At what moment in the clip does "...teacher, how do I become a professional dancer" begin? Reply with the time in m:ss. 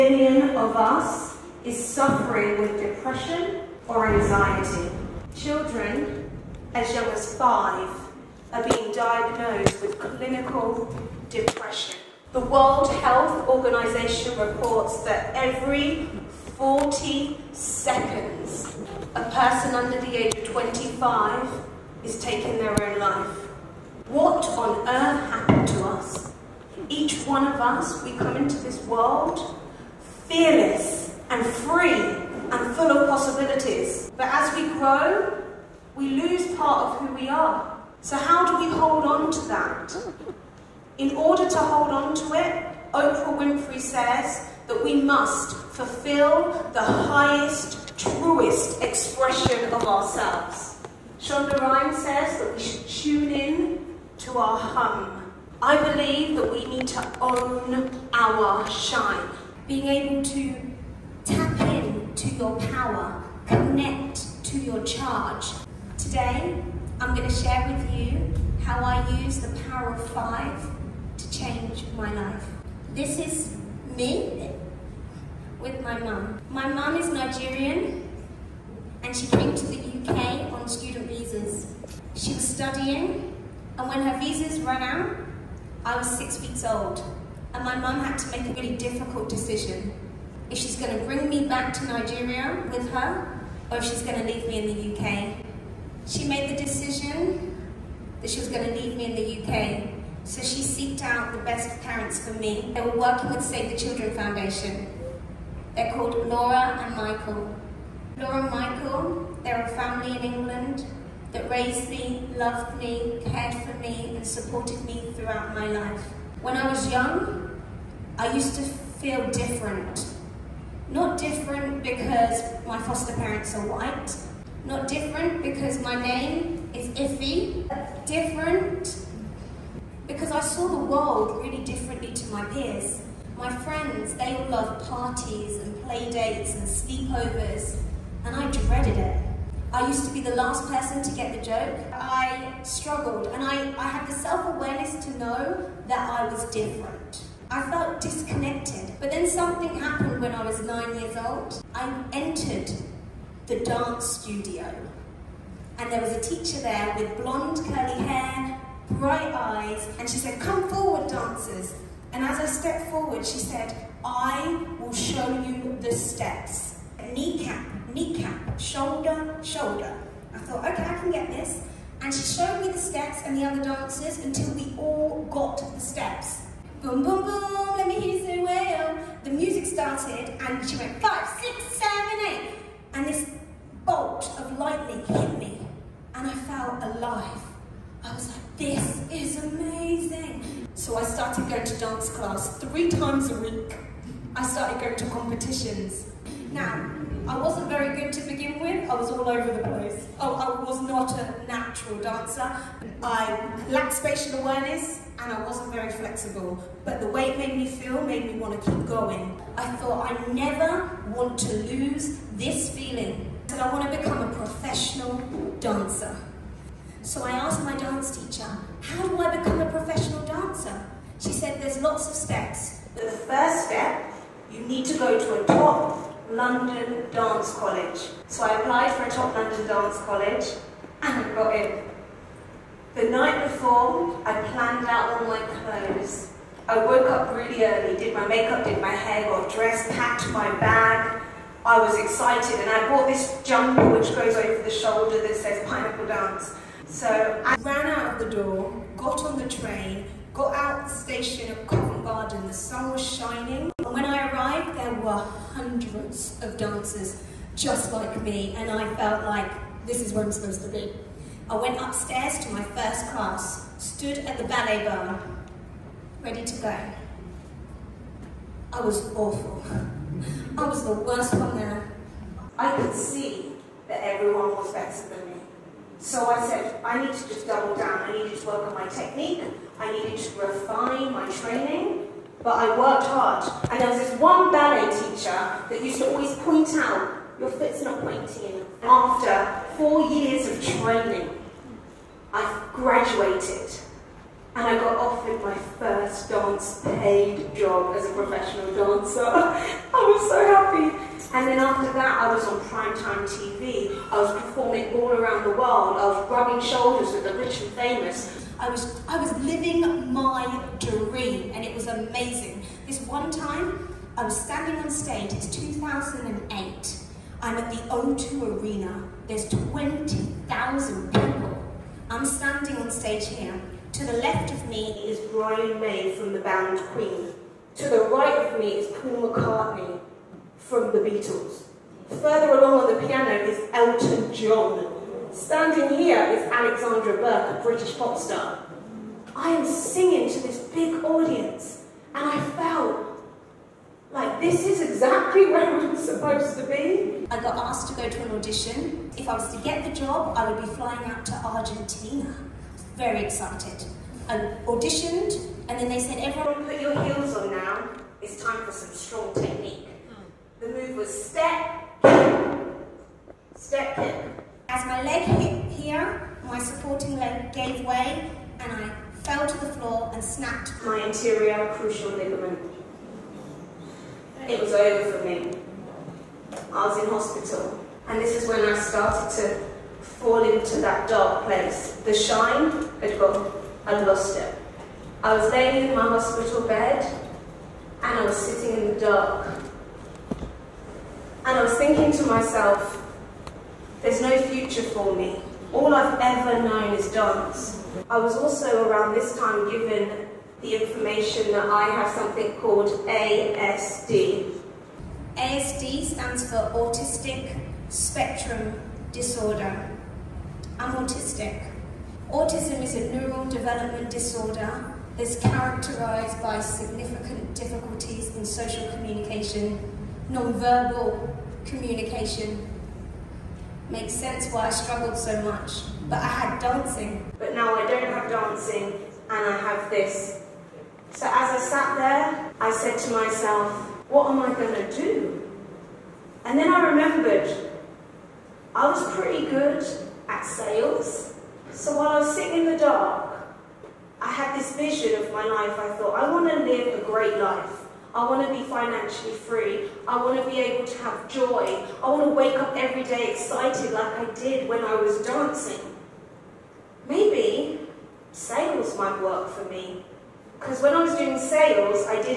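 3:38.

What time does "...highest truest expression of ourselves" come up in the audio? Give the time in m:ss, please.
0:46.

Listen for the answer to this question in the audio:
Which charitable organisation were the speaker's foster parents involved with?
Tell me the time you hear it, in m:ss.
1:43.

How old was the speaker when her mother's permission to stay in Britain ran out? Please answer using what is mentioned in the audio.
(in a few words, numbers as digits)
6 weeks old.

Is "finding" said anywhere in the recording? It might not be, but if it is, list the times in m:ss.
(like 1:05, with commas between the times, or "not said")
not said.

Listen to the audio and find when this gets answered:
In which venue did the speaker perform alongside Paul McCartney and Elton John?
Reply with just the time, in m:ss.
5:17.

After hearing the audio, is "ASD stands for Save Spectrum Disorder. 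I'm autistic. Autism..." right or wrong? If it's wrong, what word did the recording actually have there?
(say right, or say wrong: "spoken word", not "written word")
wrong: "Autistic", not "Save".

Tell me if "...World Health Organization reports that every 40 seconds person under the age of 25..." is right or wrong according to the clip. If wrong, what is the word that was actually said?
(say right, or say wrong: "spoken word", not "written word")
right.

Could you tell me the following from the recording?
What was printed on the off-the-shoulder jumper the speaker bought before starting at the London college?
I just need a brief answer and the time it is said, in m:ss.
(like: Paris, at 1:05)
Pineapple Dance, at 4:05.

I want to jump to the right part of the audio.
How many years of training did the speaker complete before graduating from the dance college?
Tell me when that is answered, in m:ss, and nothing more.
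4:49.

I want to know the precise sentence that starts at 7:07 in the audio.
But now I don't have dancing and I have this.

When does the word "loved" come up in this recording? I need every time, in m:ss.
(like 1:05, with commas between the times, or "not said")
1:52, 2:14.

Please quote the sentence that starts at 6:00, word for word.
The move was step, step kick.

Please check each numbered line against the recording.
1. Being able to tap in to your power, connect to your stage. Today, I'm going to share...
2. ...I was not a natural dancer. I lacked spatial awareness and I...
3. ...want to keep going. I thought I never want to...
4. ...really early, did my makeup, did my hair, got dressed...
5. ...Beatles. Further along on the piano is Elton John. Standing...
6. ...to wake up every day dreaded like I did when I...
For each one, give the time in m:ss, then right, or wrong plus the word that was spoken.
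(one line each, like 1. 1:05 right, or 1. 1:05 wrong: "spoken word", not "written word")
1. 0:59 wrong: "charge", not "stage"
2. 3:20 right
3. 3:28 right
4. 3:57 right
5. 5:30 right
6. 7:32 wrong: "excited", not "dreaded".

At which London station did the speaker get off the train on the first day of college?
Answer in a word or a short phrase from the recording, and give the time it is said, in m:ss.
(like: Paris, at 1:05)
Covent Garden, at 4:11.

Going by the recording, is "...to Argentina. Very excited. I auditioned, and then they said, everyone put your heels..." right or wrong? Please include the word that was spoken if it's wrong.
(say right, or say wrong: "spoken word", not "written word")
right.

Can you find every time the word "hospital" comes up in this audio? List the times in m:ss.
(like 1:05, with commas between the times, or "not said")
6:17, 6:26.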